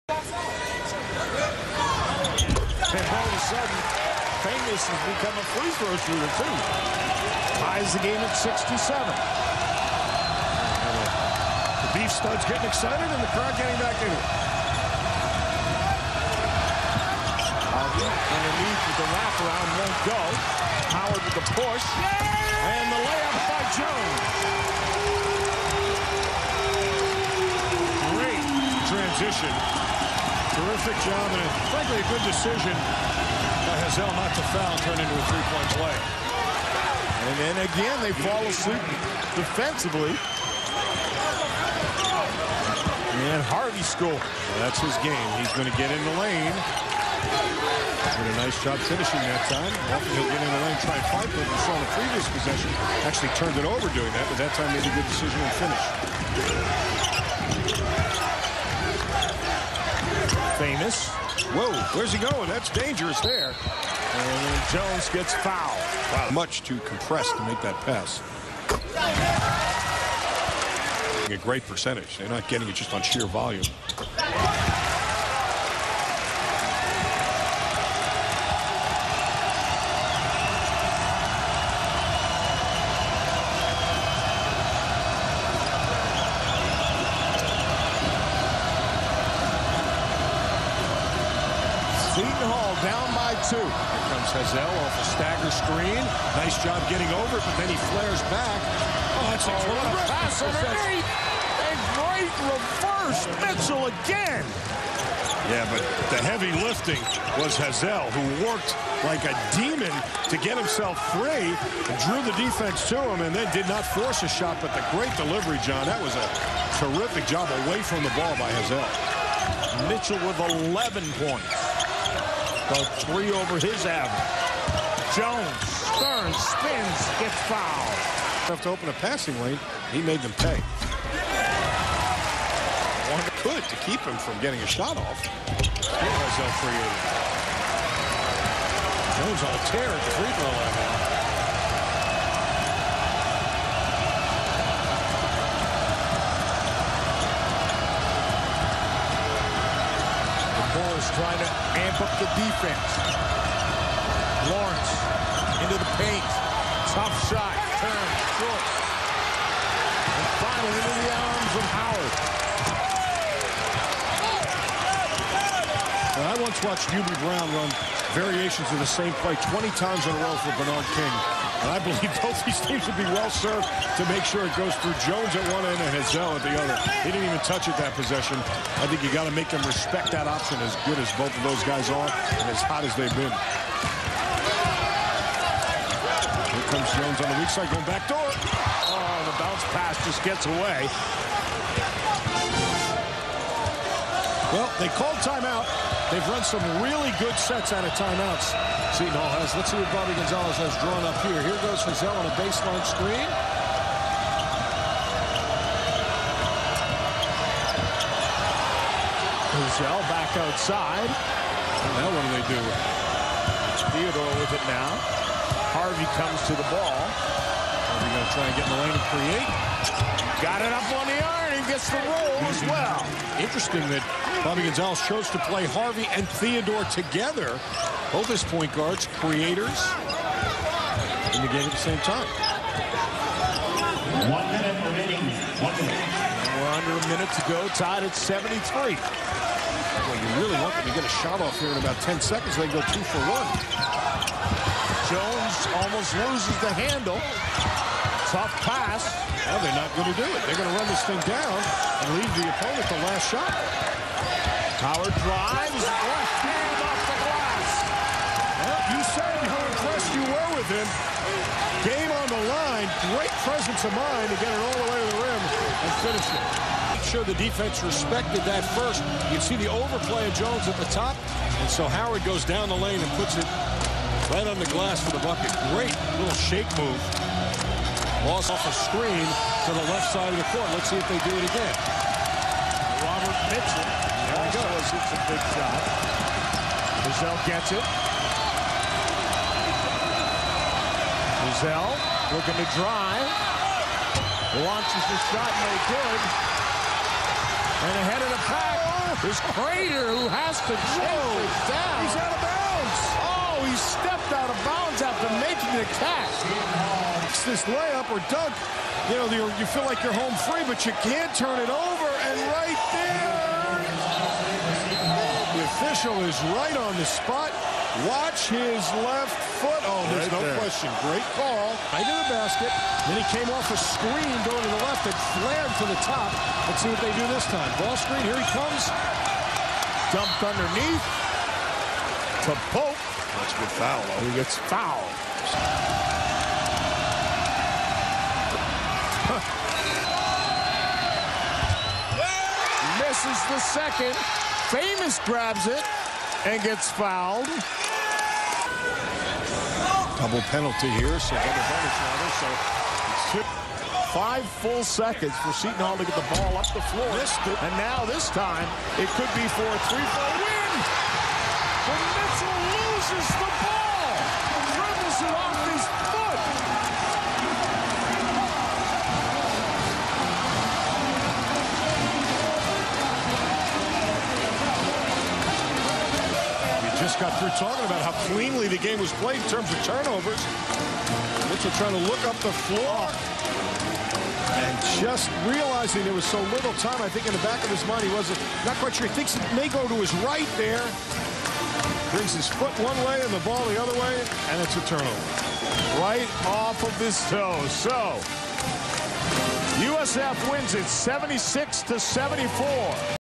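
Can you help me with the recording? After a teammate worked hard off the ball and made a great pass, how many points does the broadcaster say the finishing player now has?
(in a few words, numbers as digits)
11.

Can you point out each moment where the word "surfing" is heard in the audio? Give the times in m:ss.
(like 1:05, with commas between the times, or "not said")
not said.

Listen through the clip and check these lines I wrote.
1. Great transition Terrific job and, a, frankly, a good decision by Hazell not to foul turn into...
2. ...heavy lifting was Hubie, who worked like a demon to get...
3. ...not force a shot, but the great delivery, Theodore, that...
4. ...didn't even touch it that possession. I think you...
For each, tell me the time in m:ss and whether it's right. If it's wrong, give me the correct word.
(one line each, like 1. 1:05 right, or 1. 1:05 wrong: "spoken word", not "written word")
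1. 0:28 right
2. 1:46 wrong: "Hazell", not "Hubie"
3. 1:53 wrong: "John", not "Theodore"
4. 2:57 right.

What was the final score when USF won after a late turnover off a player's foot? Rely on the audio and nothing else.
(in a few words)
76 to 74.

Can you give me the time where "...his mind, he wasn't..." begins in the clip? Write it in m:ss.
6:27.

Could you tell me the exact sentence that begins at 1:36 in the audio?
Nice job getting over it, but then he flares back.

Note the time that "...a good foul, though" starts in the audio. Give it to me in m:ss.
5:33.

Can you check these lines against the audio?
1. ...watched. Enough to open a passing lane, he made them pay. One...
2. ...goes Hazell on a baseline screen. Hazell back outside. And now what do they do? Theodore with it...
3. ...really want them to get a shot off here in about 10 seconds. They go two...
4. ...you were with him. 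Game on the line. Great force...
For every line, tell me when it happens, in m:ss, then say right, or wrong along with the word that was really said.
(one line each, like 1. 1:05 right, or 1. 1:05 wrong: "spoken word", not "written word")
1. 2:07 wrong: "fouled", not "watched"
2. 3:21 right
3. 4:00 right
4. 4:20 wrong: "presence", not "force".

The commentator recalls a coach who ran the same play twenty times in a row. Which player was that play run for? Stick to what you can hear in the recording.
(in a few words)
Bernard King.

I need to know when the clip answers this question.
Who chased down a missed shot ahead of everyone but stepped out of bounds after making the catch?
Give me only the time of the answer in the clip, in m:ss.
4:59.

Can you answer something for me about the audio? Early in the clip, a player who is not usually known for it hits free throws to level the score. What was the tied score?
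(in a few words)
67.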